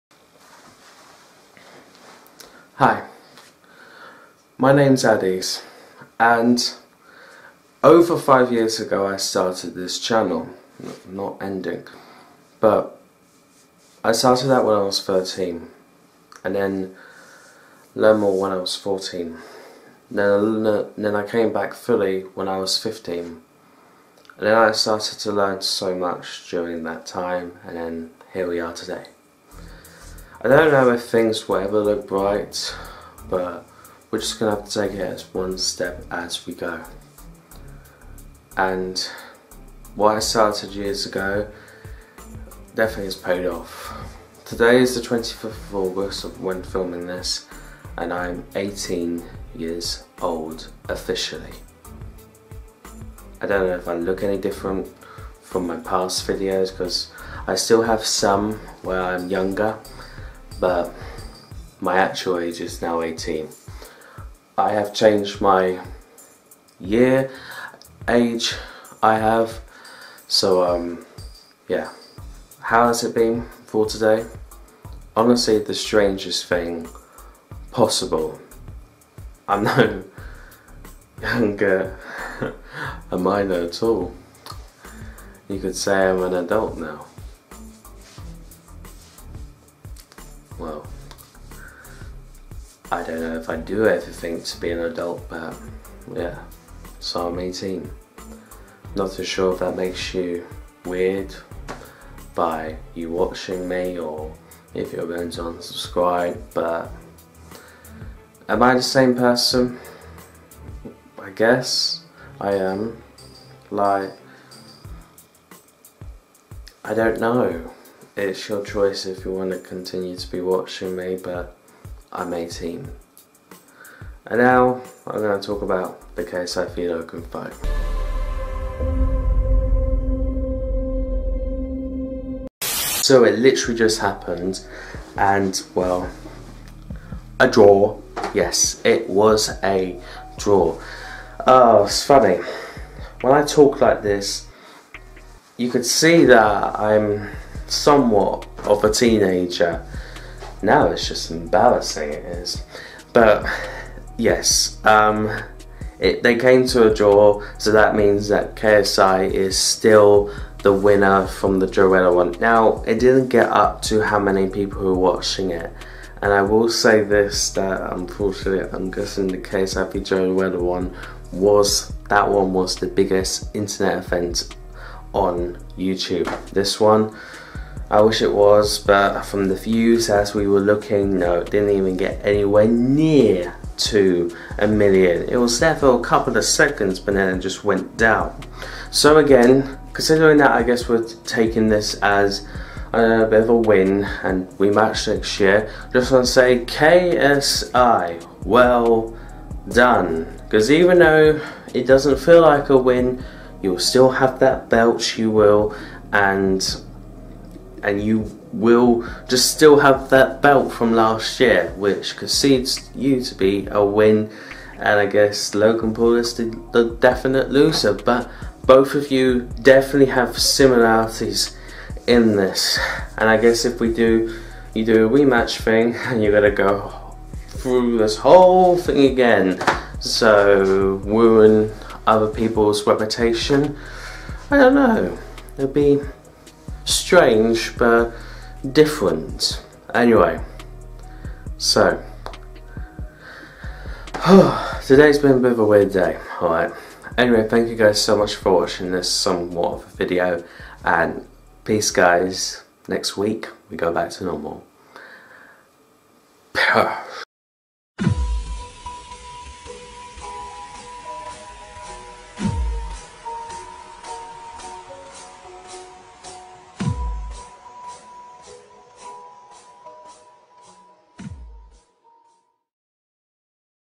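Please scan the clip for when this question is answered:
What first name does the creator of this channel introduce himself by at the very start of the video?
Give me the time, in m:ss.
0:05.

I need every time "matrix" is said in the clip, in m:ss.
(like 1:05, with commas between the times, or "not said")
not said.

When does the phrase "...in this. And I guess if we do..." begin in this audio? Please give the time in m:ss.
3:42.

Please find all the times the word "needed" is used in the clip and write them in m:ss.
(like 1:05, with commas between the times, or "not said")
not said.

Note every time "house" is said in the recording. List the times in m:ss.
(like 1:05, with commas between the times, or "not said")
not said.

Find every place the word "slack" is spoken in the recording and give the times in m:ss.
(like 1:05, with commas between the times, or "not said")
not said.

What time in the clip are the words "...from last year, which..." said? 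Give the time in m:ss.
3:30.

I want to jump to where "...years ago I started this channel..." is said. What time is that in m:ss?
0:08.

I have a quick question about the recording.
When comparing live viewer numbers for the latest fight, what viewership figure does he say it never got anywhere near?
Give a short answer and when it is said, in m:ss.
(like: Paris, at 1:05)
a million, at 3:04.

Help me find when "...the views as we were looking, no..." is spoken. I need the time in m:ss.
2:59.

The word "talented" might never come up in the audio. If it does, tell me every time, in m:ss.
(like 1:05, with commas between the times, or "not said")
not said.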